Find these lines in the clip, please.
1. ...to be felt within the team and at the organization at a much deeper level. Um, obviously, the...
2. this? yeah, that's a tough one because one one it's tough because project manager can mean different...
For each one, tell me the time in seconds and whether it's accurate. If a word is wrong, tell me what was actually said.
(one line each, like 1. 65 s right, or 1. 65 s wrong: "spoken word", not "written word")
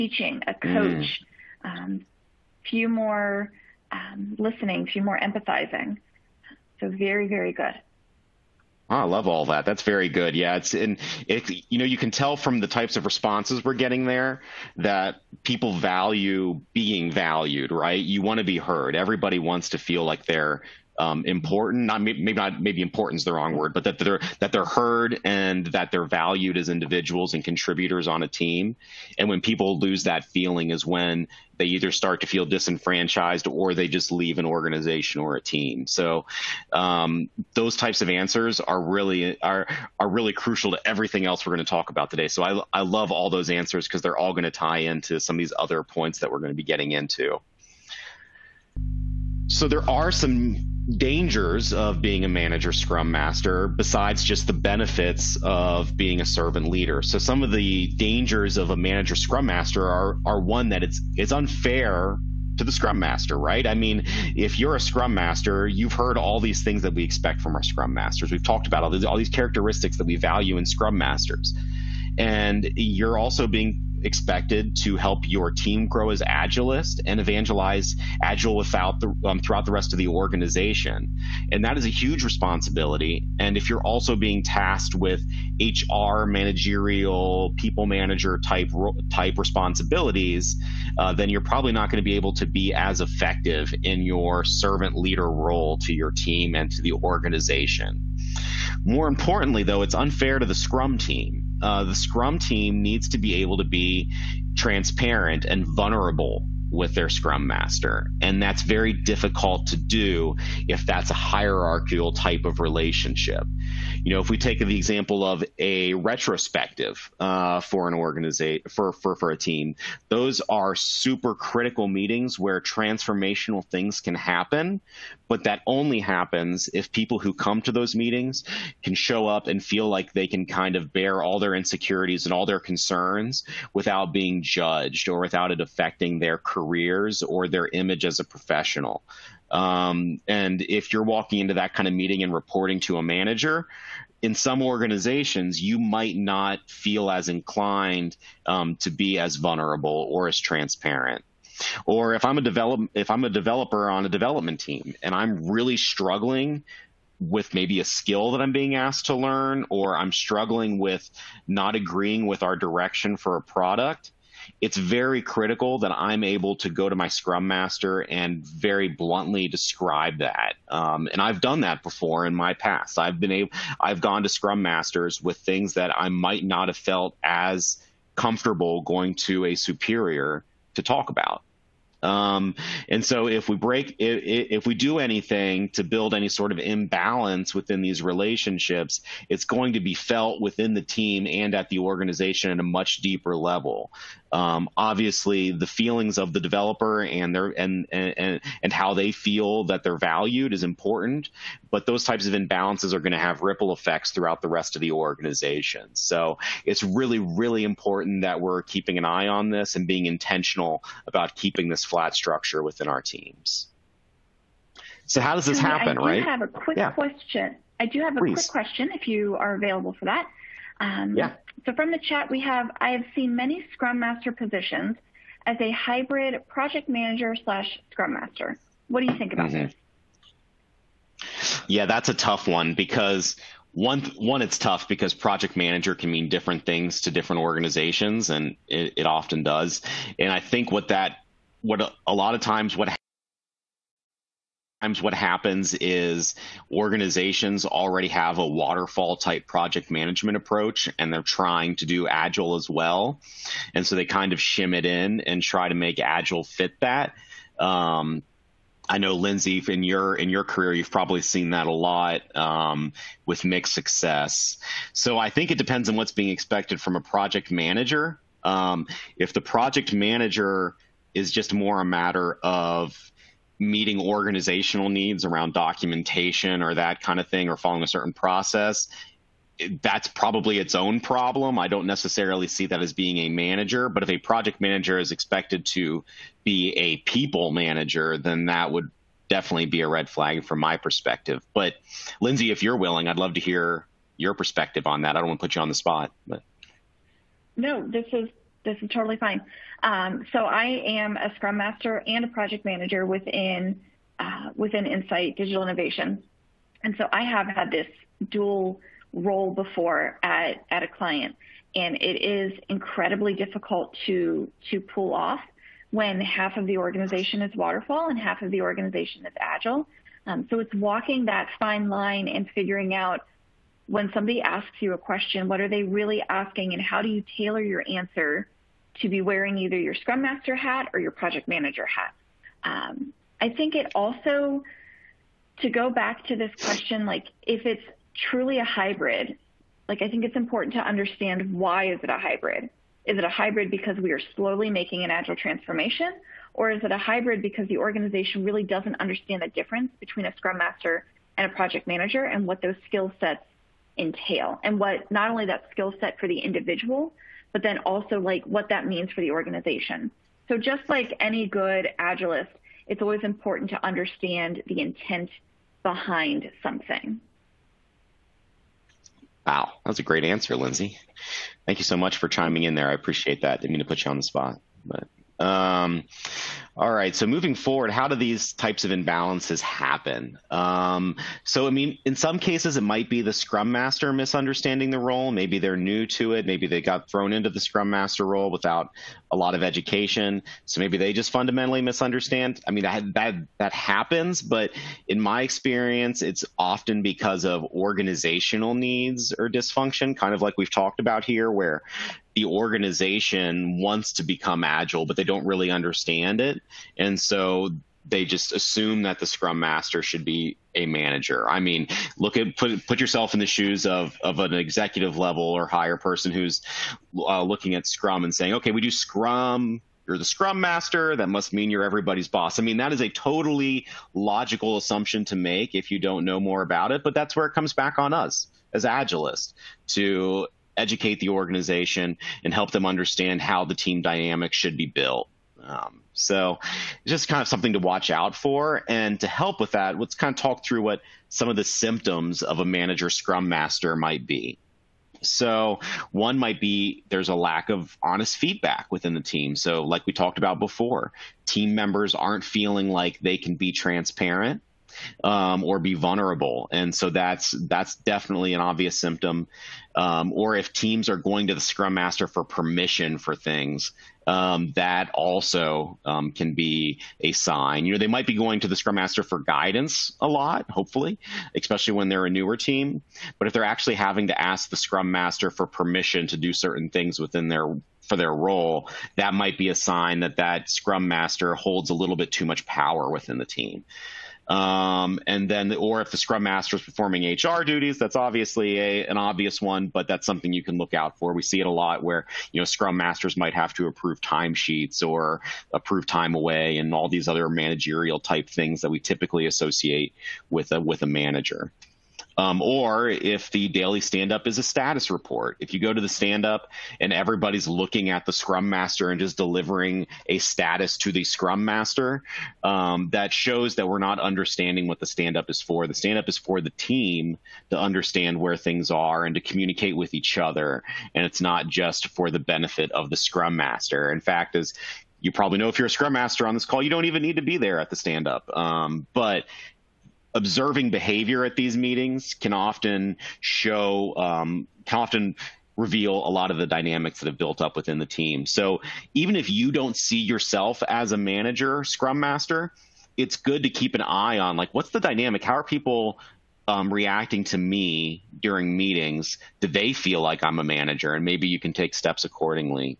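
1. 189 s right
2. 229 s right.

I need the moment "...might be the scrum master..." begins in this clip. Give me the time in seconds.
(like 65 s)
382 s.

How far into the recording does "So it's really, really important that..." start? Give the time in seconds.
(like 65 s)
205 s.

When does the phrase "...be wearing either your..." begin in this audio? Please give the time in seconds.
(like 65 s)
329 s.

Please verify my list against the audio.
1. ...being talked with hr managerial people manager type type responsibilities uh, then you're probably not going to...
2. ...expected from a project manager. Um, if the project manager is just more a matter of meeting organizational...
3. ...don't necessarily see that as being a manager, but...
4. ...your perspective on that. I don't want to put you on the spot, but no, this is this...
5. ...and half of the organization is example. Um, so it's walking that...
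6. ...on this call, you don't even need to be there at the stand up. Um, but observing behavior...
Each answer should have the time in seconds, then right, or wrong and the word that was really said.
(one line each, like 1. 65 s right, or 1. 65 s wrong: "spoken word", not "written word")
1. 84 s wrong: "tasked", not "talked"
2. 266 s right
3. 281 s right
4. 294 s right
5. 318 s wrong: "agile", not "example"
6. 526 s right.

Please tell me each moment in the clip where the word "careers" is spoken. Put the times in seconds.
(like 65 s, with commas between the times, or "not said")
136 s, 260 s.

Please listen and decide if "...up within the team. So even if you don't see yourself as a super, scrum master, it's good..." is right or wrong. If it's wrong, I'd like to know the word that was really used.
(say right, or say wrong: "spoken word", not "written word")
wrong: "manager", not "super".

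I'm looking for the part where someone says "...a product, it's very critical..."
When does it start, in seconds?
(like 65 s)
163 s.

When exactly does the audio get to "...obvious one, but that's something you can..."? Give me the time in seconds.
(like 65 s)
489 s.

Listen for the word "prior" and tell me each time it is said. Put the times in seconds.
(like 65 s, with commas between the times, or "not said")
not said.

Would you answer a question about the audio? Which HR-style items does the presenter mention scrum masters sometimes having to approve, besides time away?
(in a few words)
Timesheets.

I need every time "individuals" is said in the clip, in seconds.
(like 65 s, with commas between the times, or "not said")
26 s, 356 s.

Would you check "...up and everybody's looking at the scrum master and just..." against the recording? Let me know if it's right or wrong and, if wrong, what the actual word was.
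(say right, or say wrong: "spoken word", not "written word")
right.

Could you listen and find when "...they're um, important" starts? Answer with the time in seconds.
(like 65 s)
20 s.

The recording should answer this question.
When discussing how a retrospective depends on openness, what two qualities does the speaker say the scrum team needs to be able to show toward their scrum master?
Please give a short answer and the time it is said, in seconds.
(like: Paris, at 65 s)
Transparent and vulnerable, at 104 s.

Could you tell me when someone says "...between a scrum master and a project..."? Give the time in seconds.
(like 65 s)
349 s.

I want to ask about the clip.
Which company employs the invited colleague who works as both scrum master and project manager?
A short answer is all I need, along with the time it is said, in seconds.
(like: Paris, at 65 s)
Insight Digital Innovation, at 304 s.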